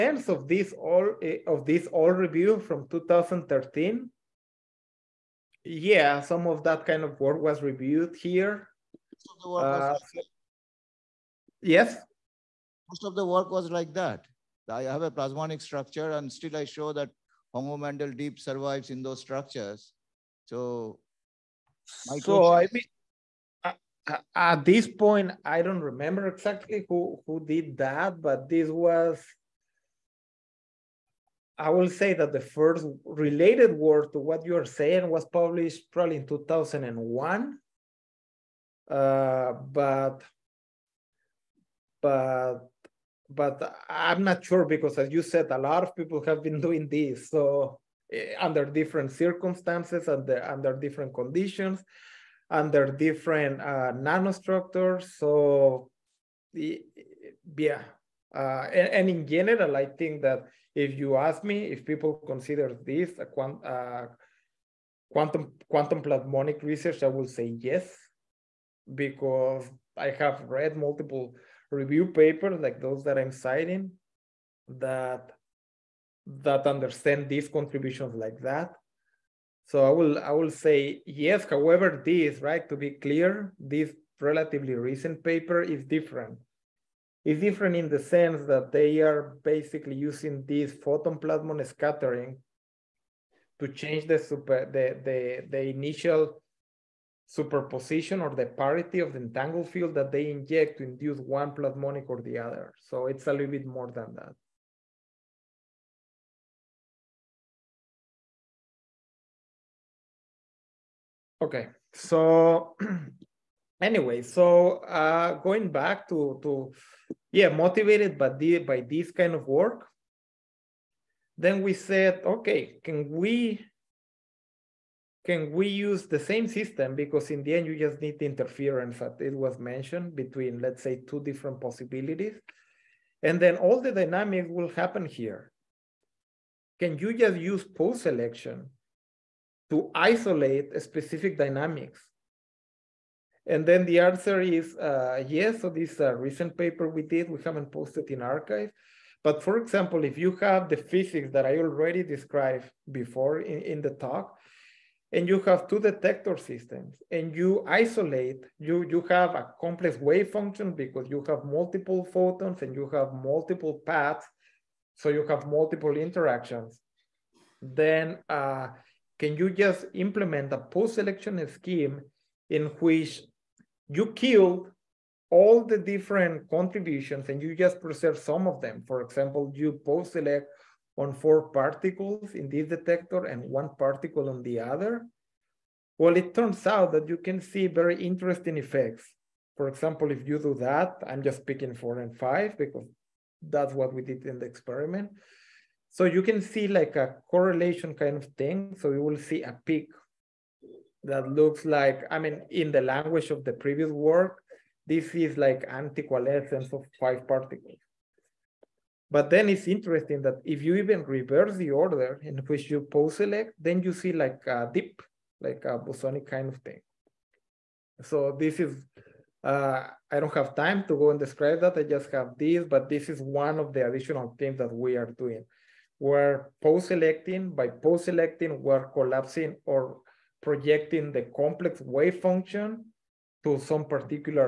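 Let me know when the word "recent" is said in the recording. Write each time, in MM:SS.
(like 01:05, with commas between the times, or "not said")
01:24, 02:26.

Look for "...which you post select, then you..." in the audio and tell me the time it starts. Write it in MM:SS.
03:32.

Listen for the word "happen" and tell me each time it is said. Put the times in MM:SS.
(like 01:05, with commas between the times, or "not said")
02:14.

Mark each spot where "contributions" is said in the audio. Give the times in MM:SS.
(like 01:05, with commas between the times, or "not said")
01:17, 02:56.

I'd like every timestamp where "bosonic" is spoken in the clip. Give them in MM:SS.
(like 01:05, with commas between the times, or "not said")
03:35.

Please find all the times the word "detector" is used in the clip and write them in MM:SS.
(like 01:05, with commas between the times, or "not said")
02:35, 03:02.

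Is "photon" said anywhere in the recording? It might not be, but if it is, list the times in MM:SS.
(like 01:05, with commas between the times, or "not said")
01:30, 02:42.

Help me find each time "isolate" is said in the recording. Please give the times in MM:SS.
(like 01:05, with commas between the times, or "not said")
02:19, 02:37.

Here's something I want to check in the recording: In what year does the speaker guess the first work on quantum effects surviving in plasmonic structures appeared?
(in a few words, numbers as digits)
2001.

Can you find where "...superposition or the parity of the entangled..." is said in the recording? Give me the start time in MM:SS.
01:37.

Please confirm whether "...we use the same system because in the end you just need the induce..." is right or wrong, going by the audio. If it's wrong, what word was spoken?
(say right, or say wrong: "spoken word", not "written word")
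wrong: "interference", not "induce".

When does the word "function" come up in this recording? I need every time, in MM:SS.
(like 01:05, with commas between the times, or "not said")
02:40, 03:52.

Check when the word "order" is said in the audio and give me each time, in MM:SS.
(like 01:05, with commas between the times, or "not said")
03:31.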